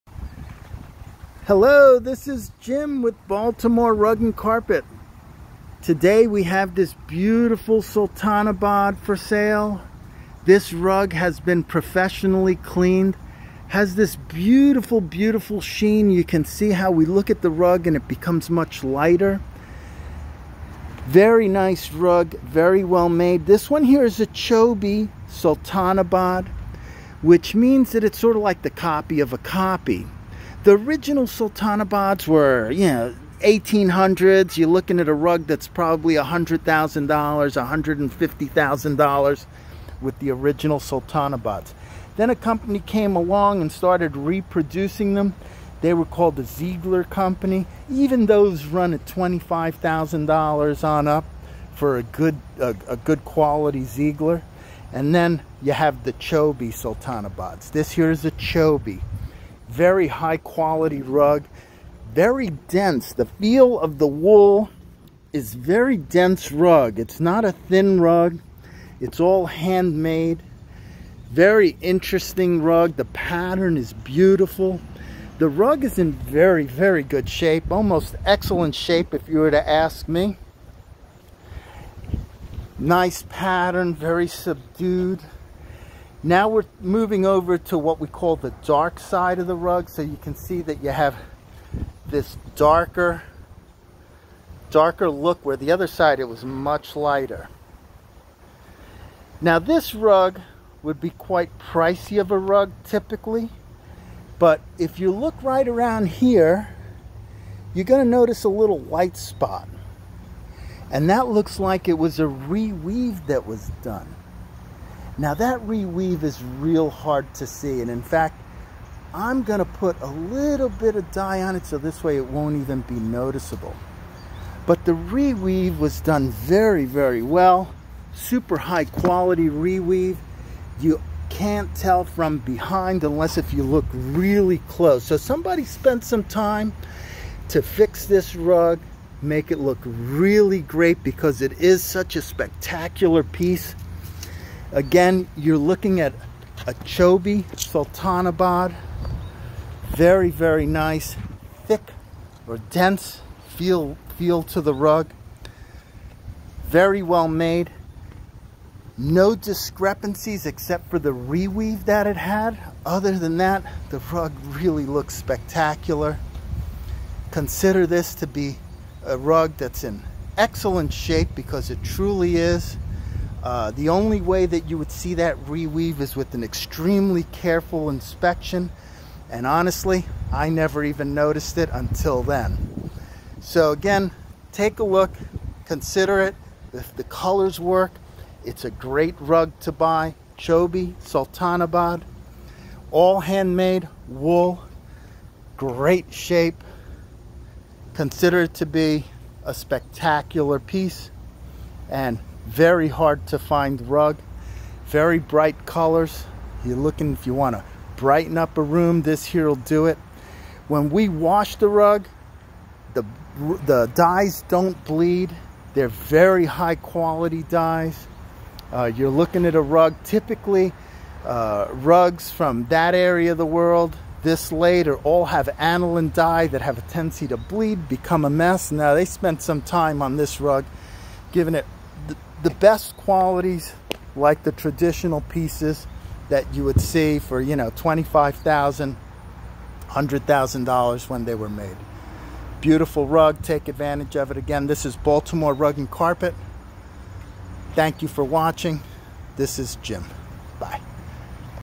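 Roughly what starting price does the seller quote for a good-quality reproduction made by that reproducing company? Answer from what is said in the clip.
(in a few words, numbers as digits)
$25,000.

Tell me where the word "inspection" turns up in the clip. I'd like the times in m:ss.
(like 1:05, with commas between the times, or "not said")
2:57.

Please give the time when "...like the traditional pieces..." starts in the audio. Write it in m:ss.
3:54.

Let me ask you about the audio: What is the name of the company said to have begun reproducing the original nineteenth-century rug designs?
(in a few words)
Ziegler Company.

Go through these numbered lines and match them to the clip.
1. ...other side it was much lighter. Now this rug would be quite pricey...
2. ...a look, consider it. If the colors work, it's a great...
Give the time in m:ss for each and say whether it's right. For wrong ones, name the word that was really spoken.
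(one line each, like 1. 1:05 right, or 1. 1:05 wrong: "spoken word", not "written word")
1. 1:35 right
2. 3:04 right.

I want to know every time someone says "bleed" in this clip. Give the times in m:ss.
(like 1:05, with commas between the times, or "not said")
3:34, 3:47.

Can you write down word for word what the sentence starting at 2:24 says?
Again, you're looking at a Chobi, Sultanabad.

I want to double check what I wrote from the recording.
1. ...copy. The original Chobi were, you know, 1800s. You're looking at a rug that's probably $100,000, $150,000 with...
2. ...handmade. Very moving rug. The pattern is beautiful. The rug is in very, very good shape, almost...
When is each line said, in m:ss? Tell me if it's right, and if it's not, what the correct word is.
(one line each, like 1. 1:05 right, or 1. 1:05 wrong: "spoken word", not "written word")
1. 0:29 wrong: "Sultanabads", not "Chobi"
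2. 1:09 wrong: "interesting", not "moving".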